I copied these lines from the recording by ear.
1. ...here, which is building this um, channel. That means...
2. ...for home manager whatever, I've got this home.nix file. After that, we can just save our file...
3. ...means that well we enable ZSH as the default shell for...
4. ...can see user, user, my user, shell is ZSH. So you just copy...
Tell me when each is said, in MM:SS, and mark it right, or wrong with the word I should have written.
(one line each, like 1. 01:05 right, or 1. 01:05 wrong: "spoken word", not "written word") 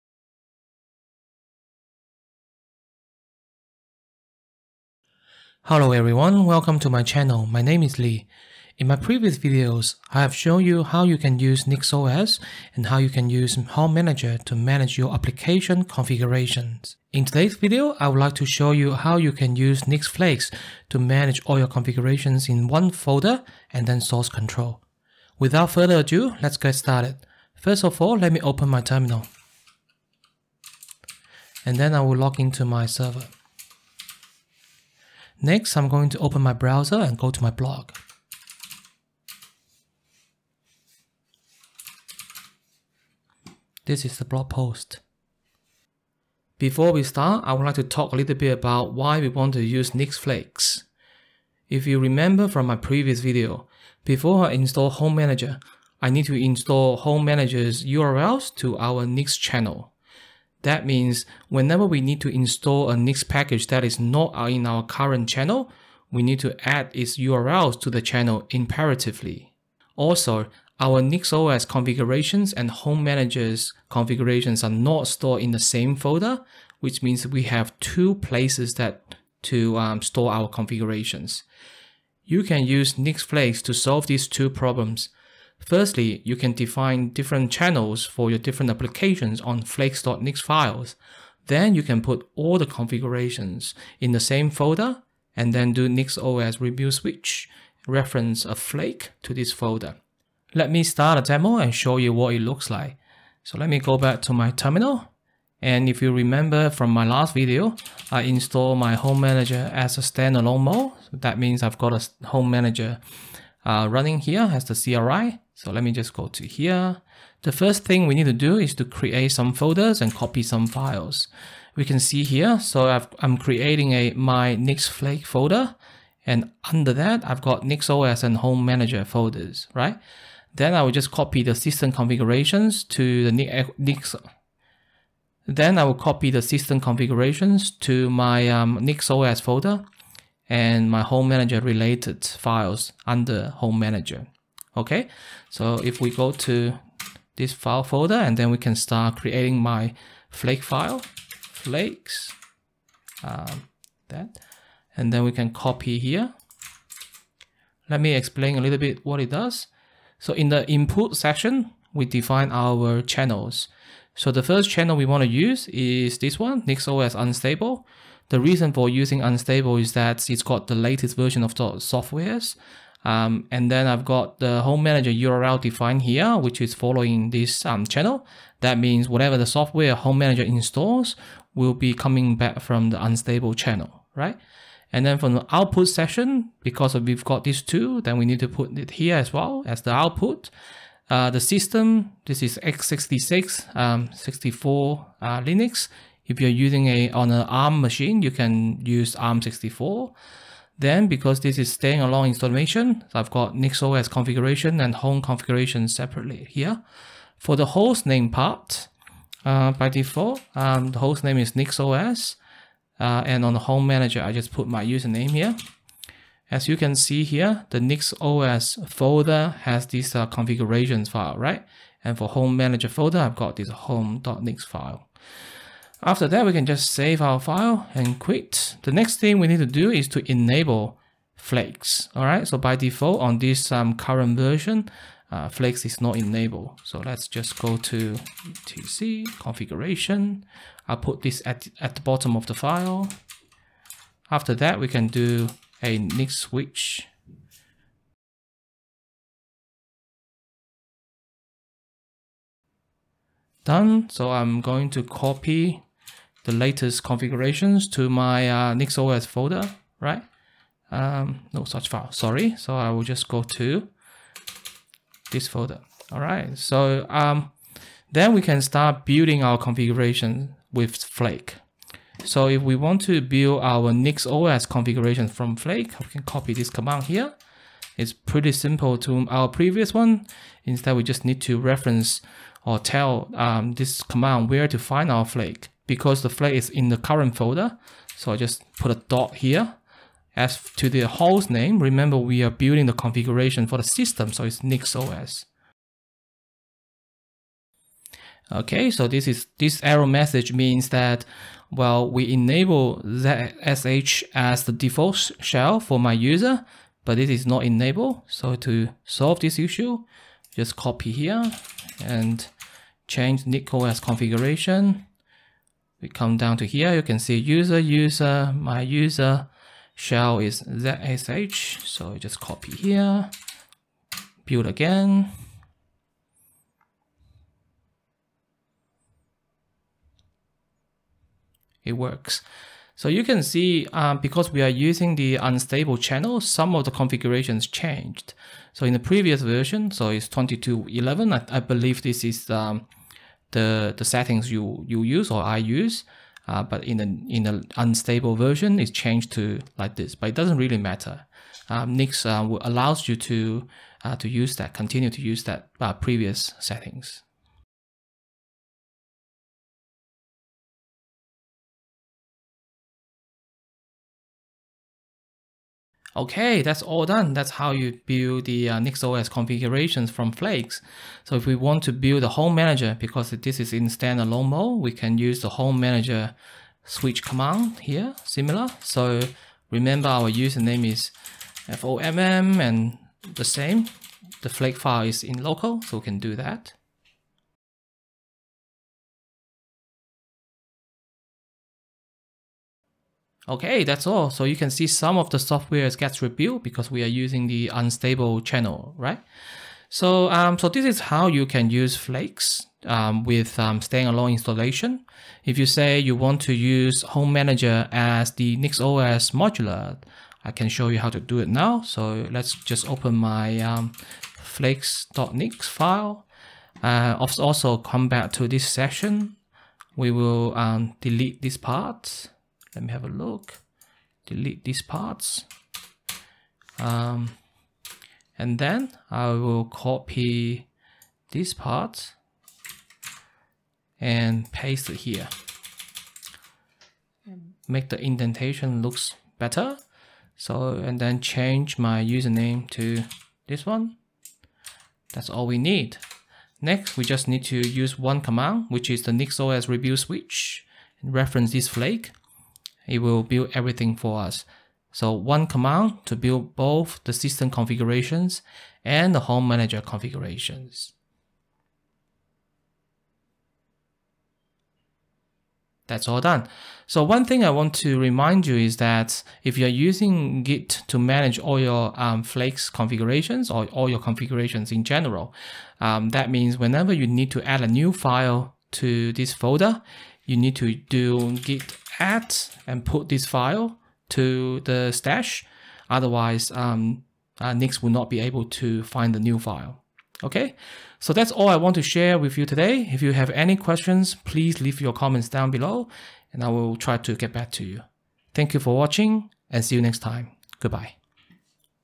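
1. 02:56 wrong: "following", not "building"
2. 03:42 wrong: "folder", not "whatever"
3. 05:00 right
4. 05:17 right.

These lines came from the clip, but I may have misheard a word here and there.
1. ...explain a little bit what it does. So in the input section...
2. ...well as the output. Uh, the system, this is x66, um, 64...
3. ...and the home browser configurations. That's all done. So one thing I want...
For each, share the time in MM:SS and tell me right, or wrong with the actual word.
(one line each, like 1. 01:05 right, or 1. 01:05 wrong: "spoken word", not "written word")
1. 02:38 right
2. 03:09 right
3. 07:38 wrong: "manager", not "browser".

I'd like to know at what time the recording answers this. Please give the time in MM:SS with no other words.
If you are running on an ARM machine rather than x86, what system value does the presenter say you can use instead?
03:19.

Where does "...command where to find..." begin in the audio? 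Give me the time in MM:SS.
04:44.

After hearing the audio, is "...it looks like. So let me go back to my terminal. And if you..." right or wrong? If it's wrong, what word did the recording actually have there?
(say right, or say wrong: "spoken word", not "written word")
right.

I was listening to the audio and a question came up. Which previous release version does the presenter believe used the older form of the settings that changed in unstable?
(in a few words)
22.11.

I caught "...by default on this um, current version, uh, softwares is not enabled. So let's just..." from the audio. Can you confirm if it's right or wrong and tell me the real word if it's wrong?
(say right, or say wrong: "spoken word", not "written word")
wrong: "flakes", not "softwares".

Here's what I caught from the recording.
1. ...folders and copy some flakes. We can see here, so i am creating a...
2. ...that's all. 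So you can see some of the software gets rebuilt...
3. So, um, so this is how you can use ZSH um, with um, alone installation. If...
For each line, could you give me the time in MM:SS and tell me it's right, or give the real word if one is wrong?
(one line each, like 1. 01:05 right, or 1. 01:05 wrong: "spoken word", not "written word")
1. 01:59 wrong: "files", not "flakes"
2. 06:33 right
3. 06:39 wrong: "Flakes", not "ZSH".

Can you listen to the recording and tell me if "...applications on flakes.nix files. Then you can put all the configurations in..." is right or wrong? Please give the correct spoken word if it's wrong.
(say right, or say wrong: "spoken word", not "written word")
right.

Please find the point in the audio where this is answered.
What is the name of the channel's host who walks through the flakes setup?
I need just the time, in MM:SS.
00:07.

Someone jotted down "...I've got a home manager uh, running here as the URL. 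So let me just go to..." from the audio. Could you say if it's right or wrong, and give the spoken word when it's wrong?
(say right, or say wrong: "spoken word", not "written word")
wrong: "CLI", not "URL".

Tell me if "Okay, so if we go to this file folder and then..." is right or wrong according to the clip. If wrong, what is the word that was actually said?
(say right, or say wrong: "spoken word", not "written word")
right.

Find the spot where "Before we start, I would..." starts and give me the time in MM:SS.
00:46.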